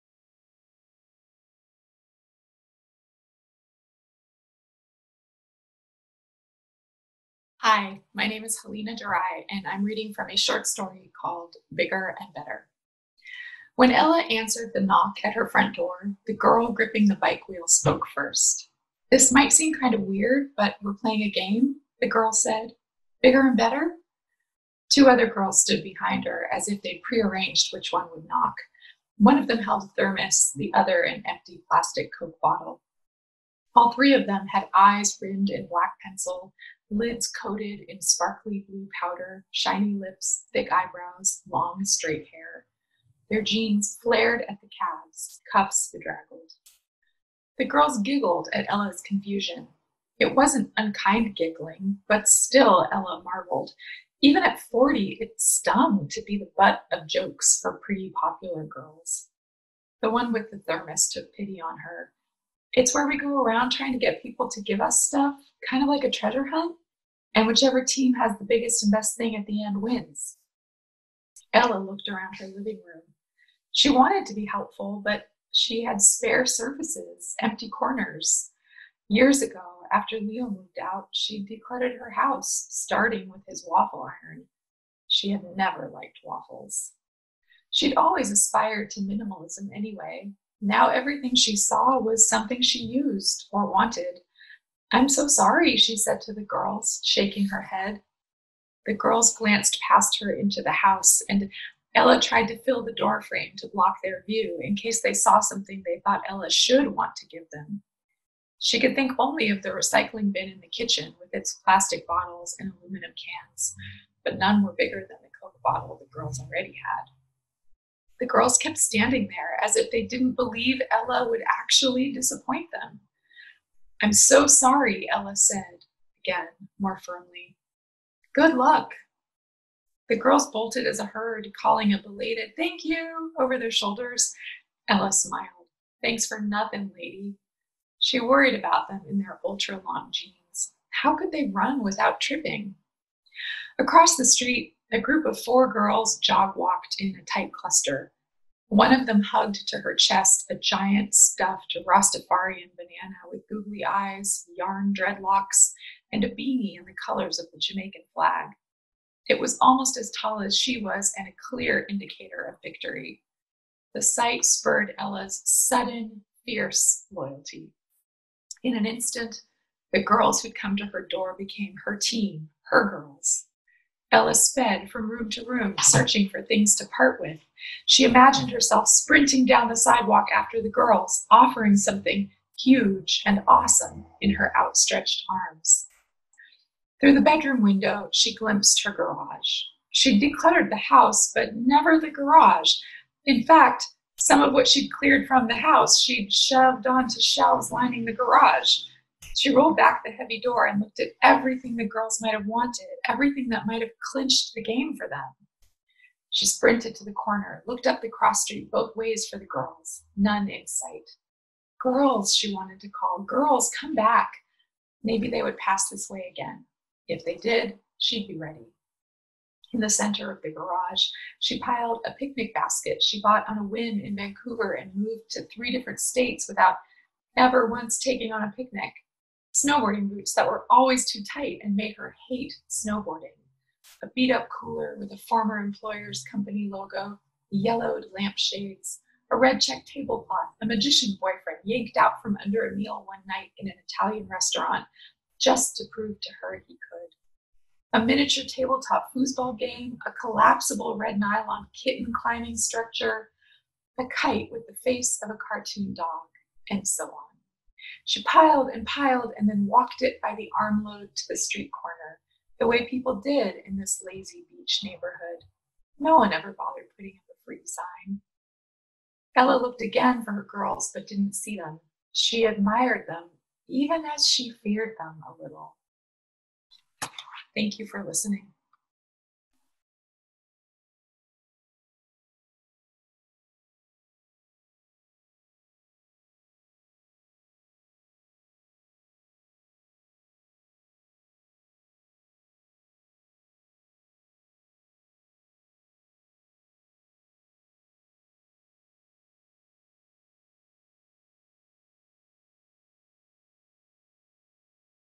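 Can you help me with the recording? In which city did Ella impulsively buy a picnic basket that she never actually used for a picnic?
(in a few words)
Vancouver.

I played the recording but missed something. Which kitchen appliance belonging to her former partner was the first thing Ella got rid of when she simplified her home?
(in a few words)
waffle iron.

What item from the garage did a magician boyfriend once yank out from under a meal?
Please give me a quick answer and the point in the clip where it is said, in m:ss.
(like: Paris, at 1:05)
red check tablecloth, at 3:59.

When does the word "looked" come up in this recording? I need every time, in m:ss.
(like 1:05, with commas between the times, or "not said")
1:11, 3:20, 3:27, 4:29.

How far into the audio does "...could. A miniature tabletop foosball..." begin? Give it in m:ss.
4:06.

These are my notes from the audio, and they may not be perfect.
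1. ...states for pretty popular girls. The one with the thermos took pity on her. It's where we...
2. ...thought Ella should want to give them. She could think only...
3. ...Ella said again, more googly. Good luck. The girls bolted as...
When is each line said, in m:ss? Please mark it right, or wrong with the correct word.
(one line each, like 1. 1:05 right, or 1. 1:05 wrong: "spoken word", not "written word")
1. 0:57 wrong: "jokes", not "states"
2. 1:46 right
3. 2:05 wrong: "firmly", not "googly".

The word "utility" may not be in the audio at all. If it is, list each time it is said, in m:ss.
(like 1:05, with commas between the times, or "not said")
not said.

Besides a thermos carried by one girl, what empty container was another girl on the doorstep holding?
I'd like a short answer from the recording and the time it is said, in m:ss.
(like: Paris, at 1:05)
plastic Coke bottle, at 0:31.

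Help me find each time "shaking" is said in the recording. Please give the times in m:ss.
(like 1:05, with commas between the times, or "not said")
1:37.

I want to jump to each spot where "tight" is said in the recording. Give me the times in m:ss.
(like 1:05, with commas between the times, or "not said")
2:27, 3:51.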